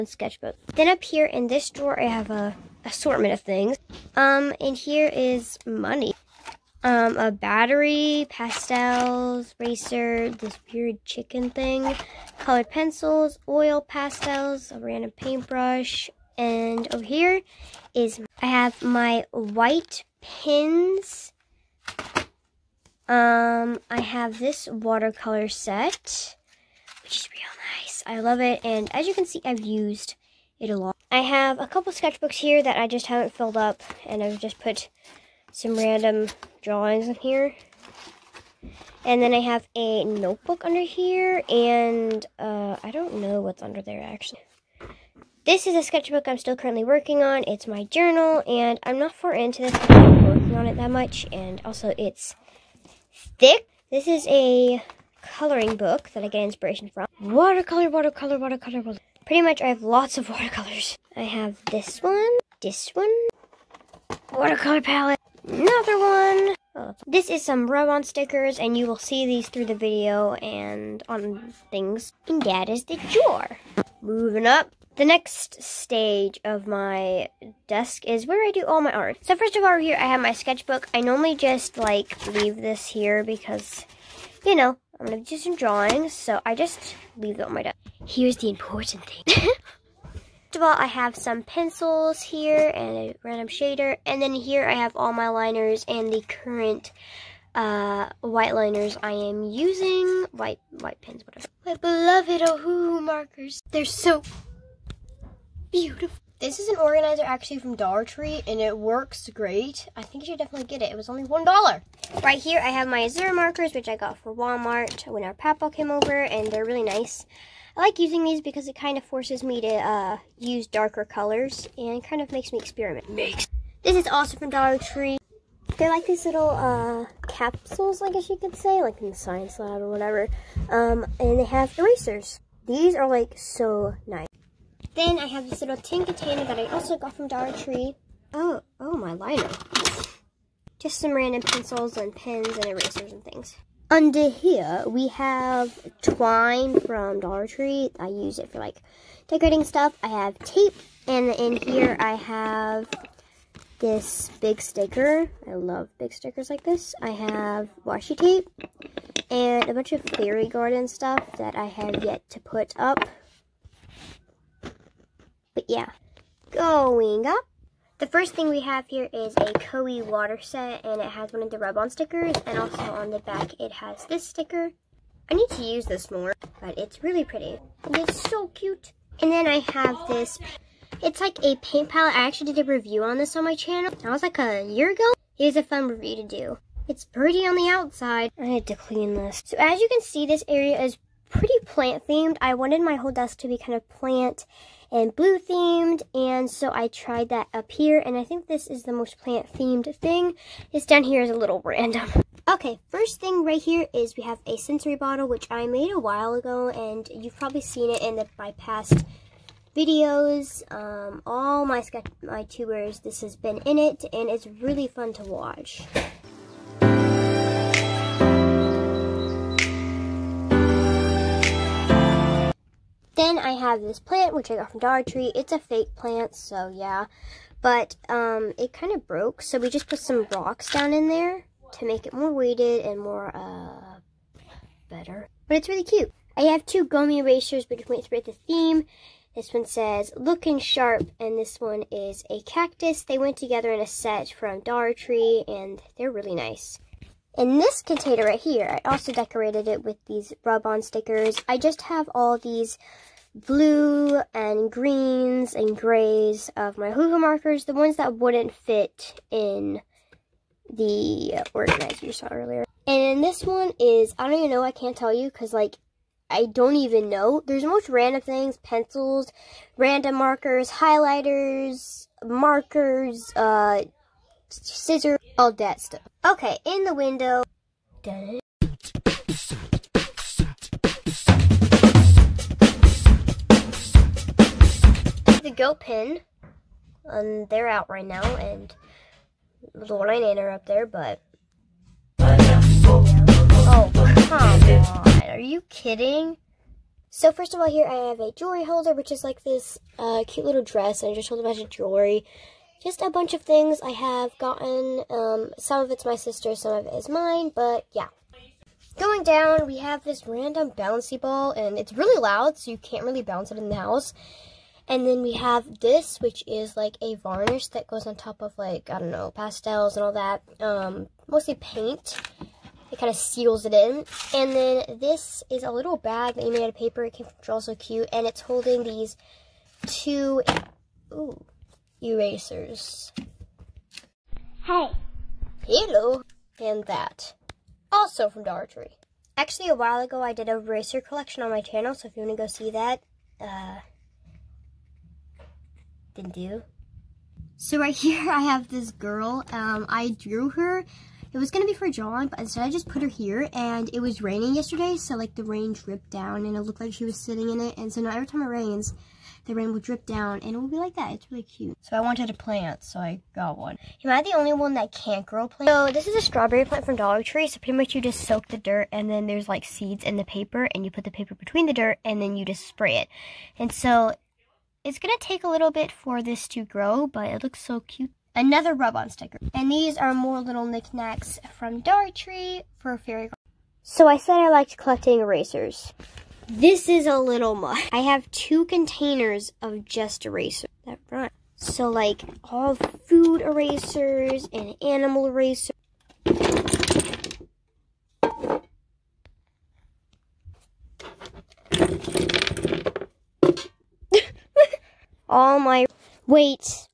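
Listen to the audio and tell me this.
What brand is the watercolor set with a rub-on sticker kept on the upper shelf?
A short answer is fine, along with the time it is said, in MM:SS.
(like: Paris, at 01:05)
Koi, at 02:49.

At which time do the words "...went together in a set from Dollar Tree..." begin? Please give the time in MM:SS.
04:03.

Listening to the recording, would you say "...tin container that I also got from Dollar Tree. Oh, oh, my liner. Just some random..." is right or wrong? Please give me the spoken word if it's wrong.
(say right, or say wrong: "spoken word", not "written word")
right.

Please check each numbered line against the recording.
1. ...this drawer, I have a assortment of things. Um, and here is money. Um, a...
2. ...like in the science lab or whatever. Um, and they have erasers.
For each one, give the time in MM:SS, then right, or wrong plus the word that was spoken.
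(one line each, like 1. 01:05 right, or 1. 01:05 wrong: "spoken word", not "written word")
1. 00:01 right
2. 02:08 right.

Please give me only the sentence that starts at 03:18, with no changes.
And I think this is the most plant themed thing.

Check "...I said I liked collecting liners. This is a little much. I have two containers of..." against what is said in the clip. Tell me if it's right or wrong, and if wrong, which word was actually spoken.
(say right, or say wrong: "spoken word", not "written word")
wrong: "erasers", not "liners".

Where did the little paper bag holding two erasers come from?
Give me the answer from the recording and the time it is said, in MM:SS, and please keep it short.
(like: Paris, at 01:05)
Draw So Cute, at 05:27.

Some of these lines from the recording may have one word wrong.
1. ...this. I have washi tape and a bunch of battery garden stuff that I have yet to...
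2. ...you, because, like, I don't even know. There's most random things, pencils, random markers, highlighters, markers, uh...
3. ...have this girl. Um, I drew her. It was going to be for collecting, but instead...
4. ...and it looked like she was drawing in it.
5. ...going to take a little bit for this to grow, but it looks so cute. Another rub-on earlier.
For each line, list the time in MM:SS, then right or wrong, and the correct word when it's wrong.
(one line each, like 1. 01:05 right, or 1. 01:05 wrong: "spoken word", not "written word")
1. 02:36 wrong: "fairy", not "battery"
2. 04:25 right
3. 05:48 wrong: "drawing", not "collecting"
4. 05:56 wrong: "sitting", not "drawing"
5. 06:14 wrong: "sticker", not "earlier".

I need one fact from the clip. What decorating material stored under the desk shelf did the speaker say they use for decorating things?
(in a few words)
twine.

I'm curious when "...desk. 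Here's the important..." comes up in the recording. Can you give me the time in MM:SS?
01:27.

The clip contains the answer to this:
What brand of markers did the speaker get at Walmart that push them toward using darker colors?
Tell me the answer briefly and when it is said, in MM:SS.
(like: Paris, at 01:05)
Azura, at 01:53.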